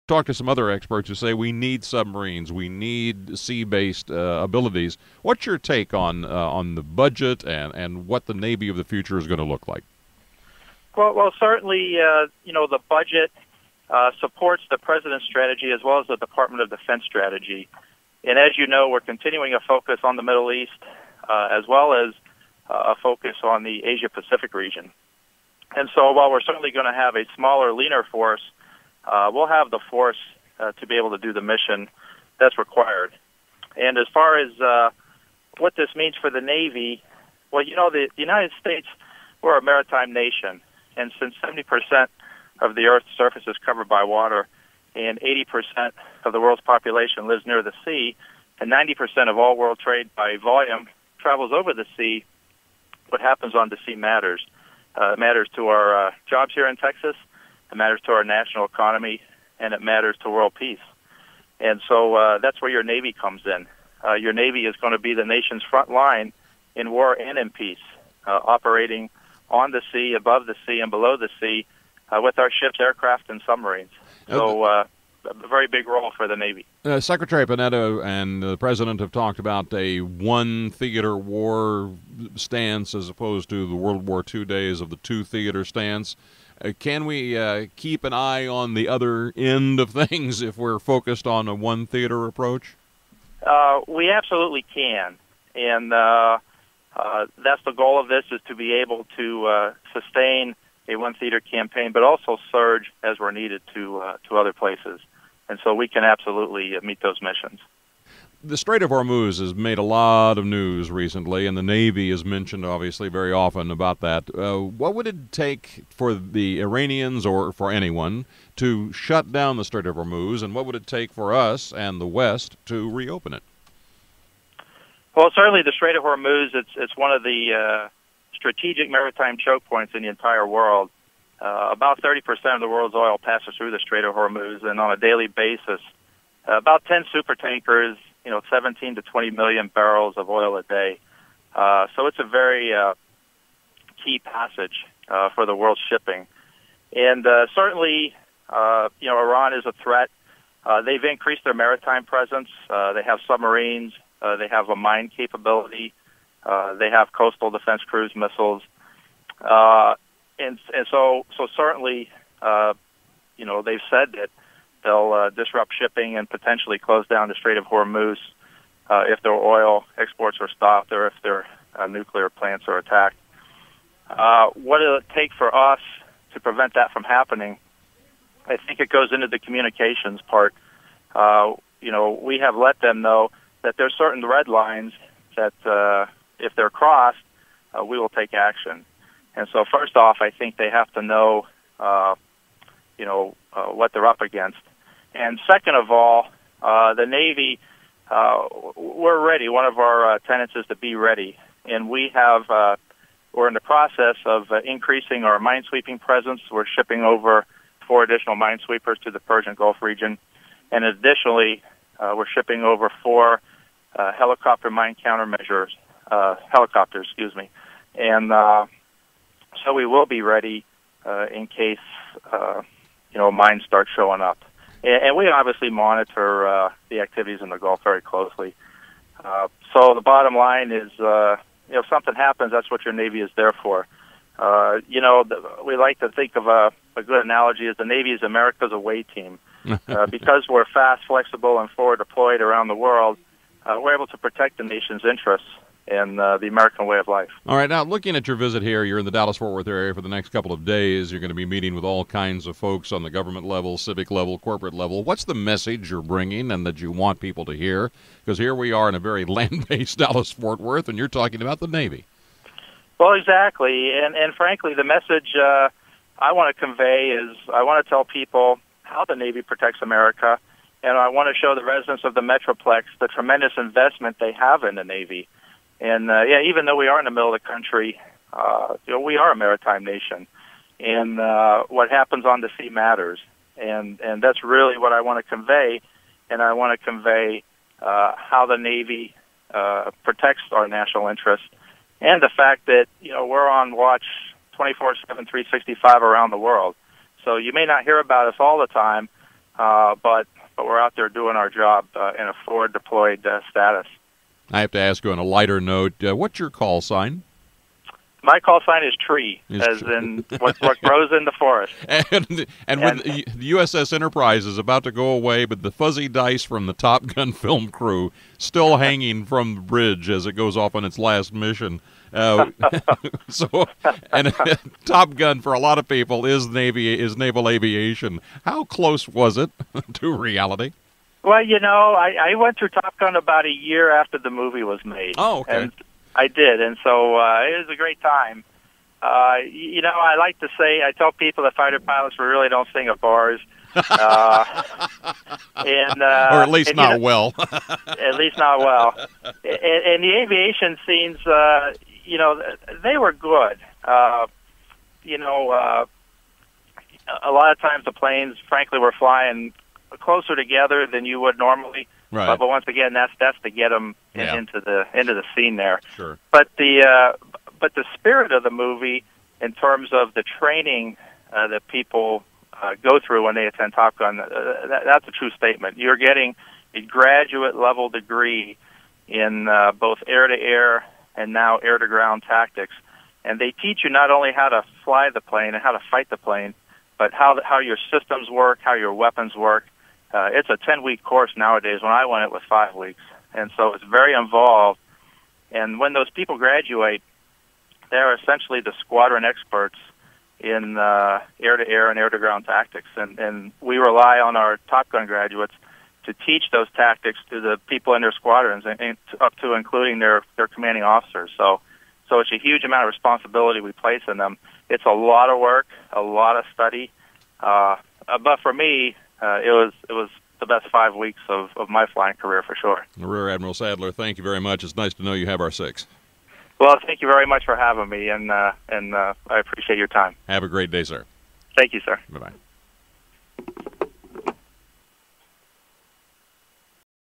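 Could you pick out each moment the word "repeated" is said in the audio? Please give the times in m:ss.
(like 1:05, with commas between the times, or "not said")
not said.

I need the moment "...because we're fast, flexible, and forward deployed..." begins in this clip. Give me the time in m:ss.
4:00.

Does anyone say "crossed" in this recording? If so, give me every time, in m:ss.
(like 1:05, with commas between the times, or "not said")
3:06.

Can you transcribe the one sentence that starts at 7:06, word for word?
Well, thank you very much for having me, and uh, and uh, I appreciate your time.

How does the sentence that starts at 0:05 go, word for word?
What's your take on uh, on the budget and and what the Navy of the future is going to look like?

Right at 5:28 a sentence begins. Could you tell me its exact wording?
How close was it to reality?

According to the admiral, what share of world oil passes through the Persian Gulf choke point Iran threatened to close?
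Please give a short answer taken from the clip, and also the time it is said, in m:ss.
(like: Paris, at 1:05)
30%, at 2:12.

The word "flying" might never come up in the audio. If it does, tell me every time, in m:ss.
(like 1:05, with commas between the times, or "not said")
5:58, 7:01.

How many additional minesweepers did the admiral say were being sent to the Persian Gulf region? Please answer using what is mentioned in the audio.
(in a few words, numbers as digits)
4.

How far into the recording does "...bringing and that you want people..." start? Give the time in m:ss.
4:16.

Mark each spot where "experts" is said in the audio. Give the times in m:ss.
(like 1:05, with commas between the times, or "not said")
0:00, 6:39.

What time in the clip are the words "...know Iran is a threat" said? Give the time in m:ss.
2:29.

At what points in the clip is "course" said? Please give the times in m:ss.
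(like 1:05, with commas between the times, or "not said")
6:31.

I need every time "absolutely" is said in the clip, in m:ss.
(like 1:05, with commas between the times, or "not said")
1:34, 1:46.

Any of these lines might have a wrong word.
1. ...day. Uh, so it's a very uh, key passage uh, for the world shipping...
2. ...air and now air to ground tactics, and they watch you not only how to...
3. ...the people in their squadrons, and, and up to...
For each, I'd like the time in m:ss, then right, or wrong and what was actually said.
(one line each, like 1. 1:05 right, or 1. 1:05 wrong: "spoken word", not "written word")
1. 2:20 right
2. 6:20 wrong: "teach", not "watch"
3. 6:47 right.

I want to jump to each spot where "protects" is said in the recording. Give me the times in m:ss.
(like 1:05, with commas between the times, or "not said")
4:04, 4:29, 4:50.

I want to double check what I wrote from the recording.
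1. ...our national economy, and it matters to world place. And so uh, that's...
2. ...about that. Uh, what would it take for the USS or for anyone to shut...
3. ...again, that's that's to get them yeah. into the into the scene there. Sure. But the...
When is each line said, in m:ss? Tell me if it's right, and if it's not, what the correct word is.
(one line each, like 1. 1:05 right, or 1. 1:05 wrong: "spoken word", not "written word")
1. 0:58 wrong: "peace", not "place"
2. 1:53 wrong: "Iranians", not "USS"
3. 6:02 right.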